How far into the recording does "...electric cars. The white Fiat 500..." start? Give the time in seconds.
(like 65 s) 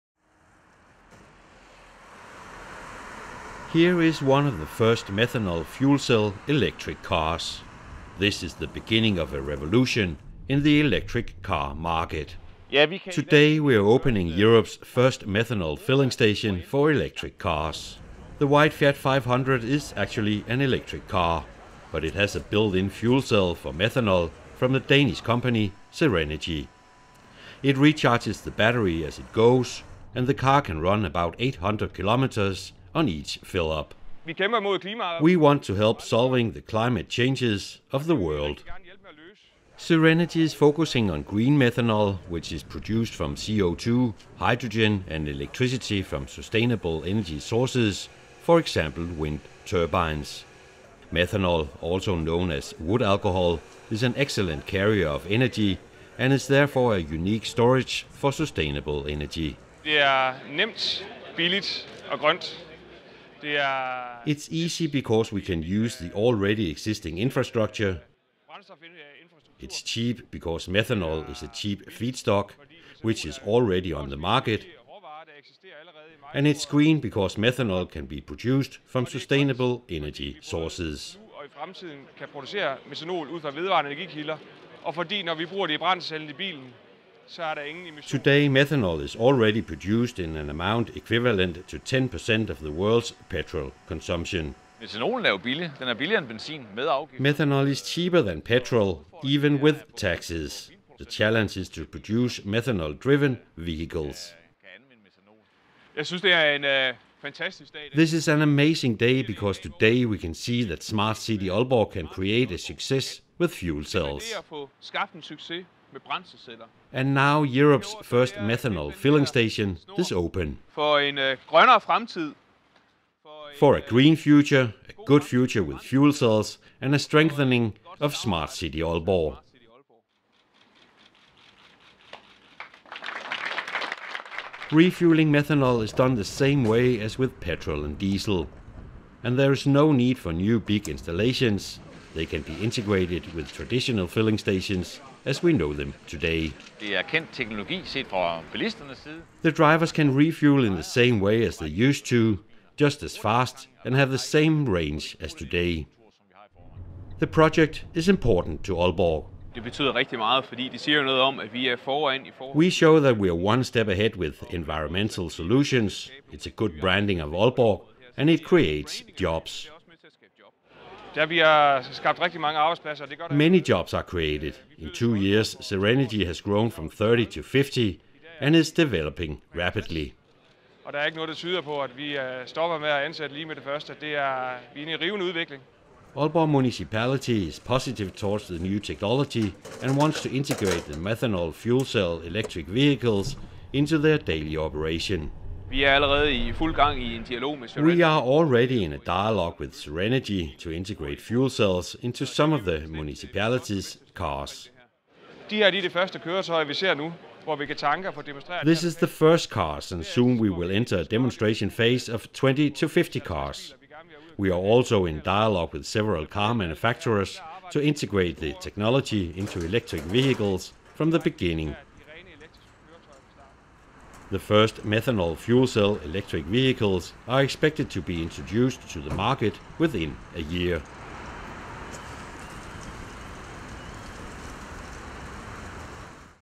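16 s.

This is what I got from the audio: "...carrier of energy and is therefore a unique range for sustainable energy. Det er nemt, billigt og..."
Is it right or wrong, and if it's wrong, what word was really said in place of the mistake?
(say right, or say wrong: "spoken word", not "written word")
wrong: "storage", not "range".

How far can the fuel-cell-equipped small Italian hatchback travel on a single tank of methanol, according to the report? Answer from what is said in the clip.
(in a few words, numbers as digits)
800 kilometers.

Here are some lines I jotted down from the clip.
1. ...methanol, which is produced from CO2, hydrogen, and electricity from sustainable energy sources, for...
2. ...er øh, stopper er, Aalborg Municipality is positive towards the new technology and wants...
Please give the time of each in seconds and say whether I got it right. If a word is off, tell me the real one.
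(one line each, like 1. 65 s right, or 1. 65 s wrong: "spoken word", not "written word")
1. 41 s right
2. 180 s right.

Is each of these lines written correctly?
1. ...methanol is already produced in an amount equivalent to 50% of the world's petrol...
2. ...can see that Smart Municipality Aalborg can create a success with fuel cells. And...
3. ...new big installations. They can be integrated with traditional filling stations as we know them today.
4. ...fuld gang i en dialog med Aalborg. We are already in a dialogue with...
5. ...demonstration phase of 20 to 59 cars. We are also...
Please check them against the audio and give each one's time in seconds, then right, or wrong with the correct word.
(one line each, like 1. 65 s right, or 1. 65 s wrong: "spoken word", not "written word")
1. 88 s wrong: "10", not "50"
2. 110 s wrong: "City", not "Municipality"
3. 140 s right
4. 196 s wrong: "Serenity", not "Aalborg"
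5. 211 s wrong: "50", not "59".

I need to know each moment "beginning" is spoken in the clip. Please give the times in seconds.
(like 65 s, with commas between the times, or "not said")
8 s, 221 s.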